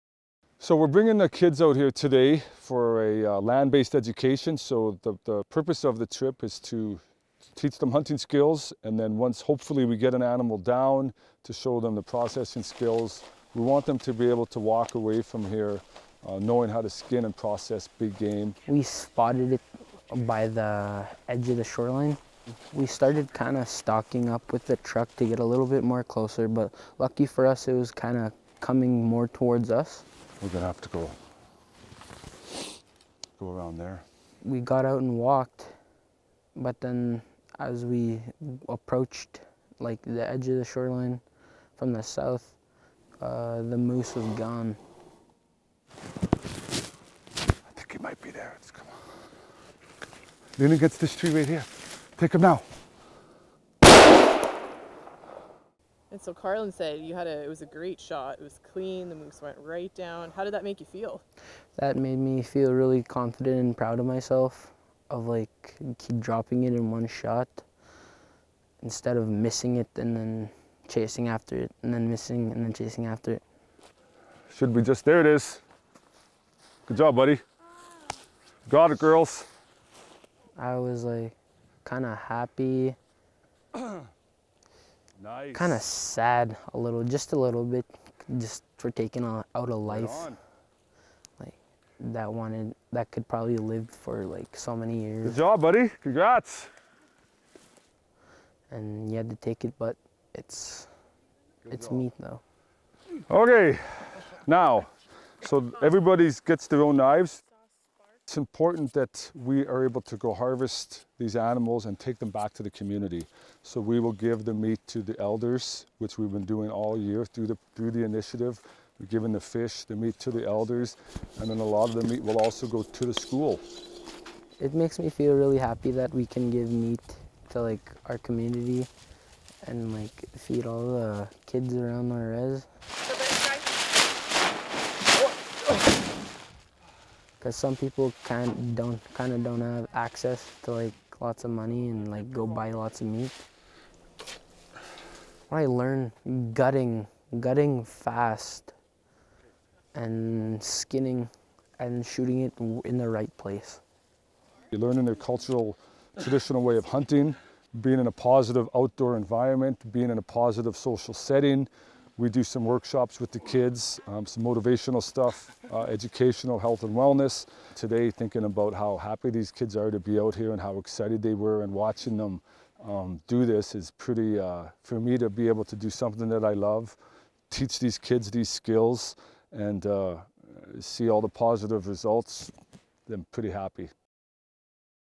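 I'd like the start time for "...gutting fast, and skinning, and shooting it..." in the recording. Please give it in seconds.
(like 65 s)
147 s.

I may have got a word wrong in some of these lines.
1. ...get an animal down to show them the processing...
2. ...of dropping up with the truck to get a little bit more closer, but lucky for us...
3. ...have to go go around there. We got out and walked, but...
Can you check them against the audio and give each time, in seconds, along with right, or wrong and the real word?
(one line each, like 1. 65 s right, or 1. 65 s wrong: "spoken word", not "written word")
1. 9 s right
2. 23 s wrong: "stocking", not "dropping"
3. 30 s right.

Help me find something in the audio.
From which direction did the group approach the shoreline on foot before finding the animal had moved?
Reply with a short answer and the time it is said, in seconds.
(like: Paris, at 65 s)
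South, at 42 s.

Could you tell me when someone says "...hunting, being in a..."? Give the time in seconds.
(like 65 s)
156 s.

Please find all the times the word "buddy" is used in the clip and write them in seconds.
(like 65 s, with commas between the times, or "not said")
77 s, 95 s.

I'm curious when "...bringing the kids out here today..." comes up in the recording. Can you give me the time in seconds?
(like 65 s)
0 s.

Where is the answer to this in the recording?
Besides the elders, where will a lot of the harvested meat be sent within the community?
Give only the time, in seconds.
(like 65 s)
123 s.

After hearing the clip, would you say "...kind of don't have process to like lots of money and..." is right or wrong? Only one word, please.
wrong.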